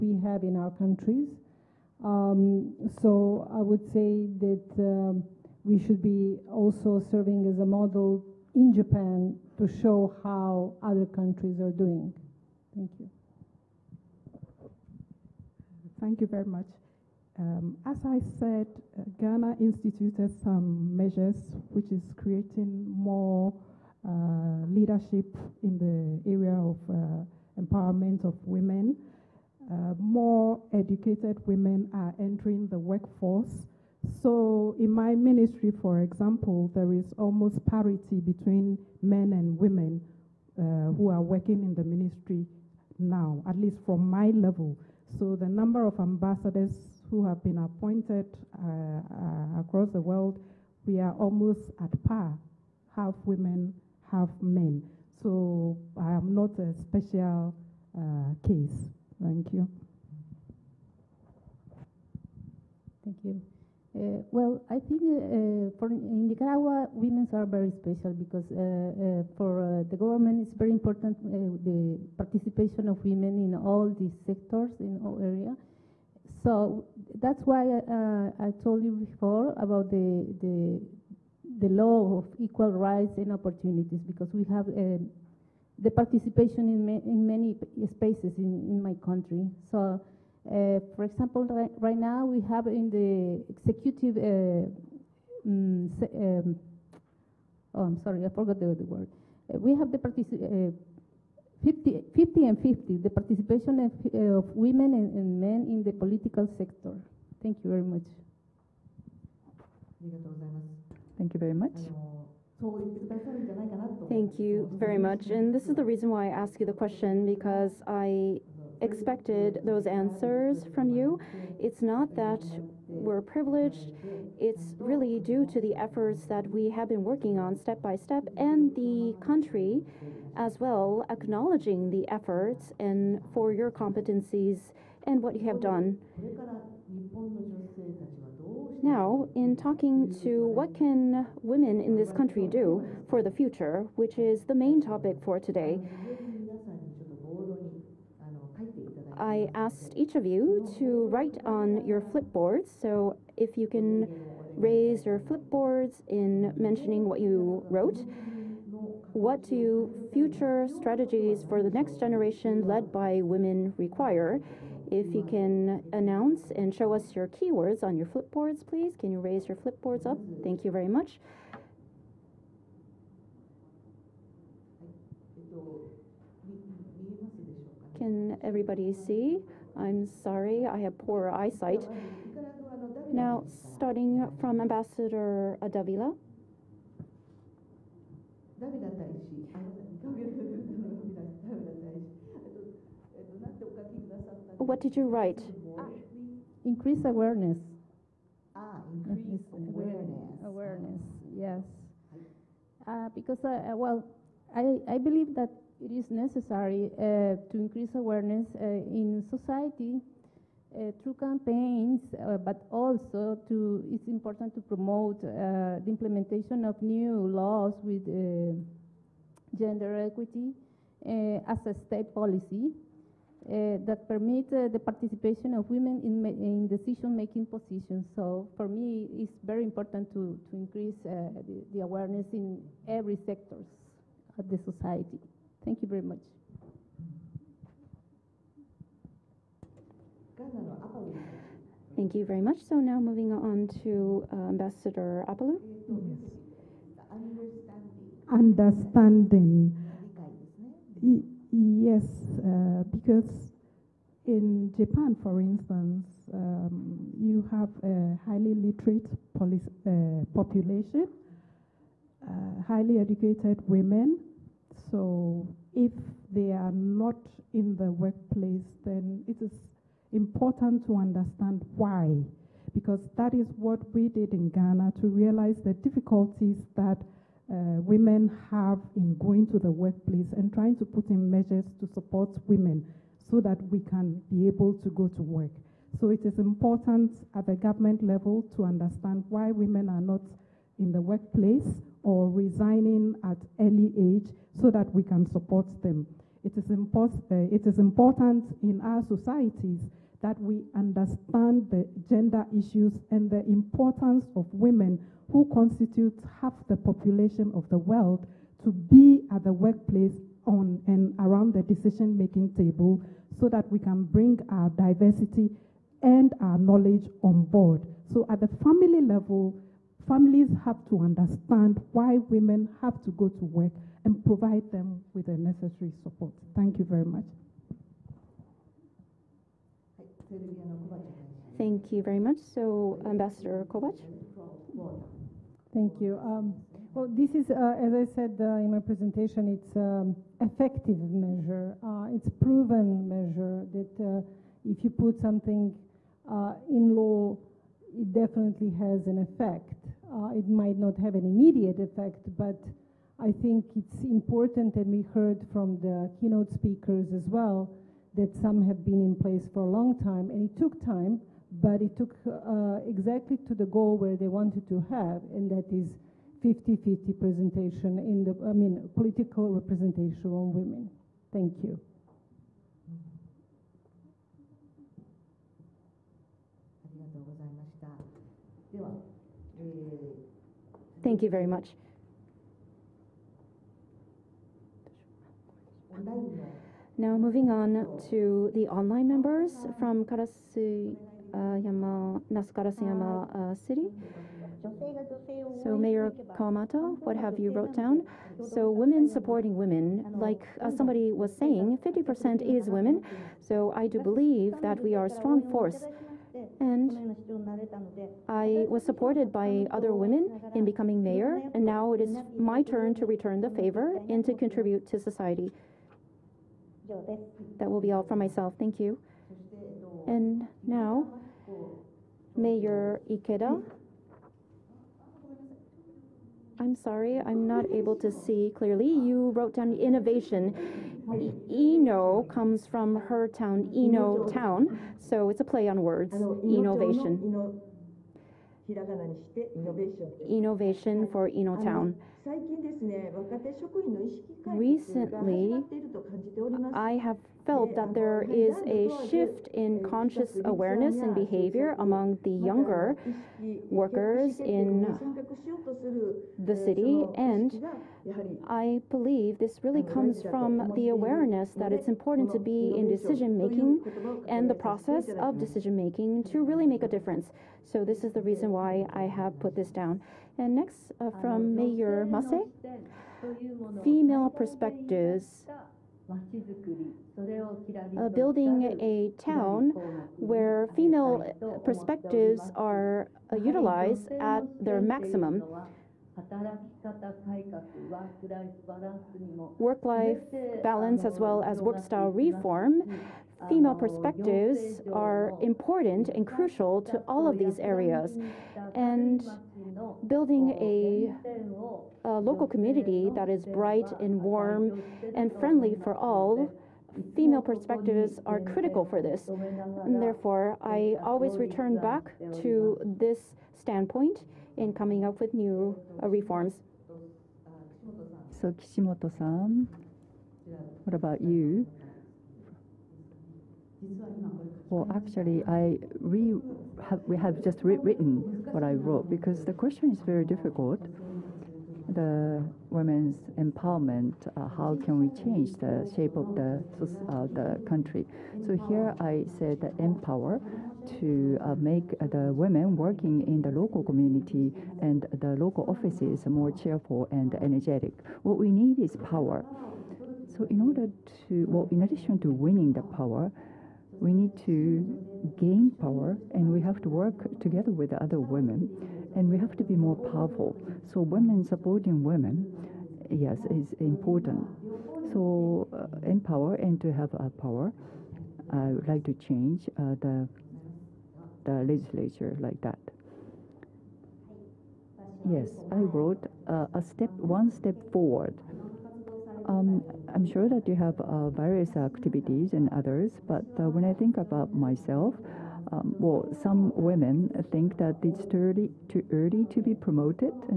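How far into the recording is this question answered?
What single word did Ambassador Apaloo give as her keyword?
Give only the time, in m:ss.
4:08.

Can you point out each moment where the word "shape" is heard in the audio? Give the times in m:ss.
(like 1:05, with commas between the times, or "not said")
8:55.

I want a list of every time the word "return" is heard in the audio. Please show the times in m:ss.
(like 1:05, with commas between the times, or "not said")
6:53, 8:31.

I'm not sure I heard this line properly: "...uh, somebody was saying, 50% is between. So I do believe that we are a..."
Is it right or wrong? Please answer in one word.
wrong.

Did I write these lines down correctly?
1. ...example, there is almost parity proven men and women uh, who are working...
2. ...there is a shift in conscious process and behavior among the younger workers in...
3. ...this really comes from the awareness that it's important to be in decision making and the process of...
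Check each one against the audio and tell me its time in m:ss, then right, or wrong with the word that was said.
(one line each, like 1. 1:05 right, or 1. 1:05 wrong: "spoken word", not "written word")
1. 0:36 wrong: "between", not "proven"
2. 7:27 wrong: "awareness", not "process"
3. 7:39 right.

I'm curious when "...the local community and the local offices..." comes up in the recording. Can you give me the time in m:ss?
9:03.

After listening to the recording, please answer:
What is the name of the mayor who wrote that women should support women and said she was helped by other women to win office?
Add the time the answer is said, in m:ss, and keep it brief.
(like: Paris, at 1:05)
Kawamata, at 6:36.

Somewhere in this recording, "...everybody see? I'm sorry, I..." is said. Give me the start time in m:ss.
2:58.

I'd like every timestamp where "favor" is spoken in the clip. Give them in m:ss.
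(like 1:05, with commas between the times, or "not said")
6:53.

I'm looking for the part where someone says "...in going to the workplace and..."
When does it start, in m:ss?
4:38.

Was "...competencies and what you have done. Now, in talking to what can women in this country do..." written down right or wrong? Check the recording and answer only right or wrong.
right.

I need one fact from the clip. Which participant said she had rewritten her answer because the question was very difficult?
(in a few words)
Kishimoto.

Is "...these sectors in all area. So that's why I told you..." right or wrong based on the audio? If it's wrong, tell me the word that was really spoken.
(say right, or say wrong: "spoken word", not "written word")
right.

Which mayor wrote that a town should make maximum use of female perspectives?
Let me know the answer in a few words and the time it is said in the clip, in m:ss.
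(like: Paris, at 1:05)
Mase, at 7:52.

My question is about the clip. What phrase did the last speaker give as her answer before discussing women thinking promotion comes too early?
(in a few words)
One step forward.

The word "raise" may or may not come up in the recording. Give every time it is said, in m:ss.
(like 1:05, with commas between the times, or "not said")
2:34, 2:49.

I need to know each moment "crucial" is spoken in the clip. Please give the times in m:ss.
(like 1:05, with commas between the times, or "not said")
8:16.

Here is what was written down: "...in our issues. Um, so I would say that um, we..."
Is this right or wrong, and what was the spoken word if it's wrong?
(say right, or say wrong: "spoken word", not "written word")
wrong: "countries", not "issues".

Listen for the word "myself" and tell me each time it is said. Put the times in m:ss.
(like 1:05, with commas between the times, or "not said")
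6:58, 9:44.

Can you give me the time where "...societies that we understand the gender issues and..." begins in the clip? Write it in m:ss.
4:59.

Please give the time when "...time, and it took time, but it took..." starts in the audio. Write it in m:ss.
6:00.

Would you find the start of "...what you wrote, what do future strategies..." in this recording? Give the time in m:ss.
2:37.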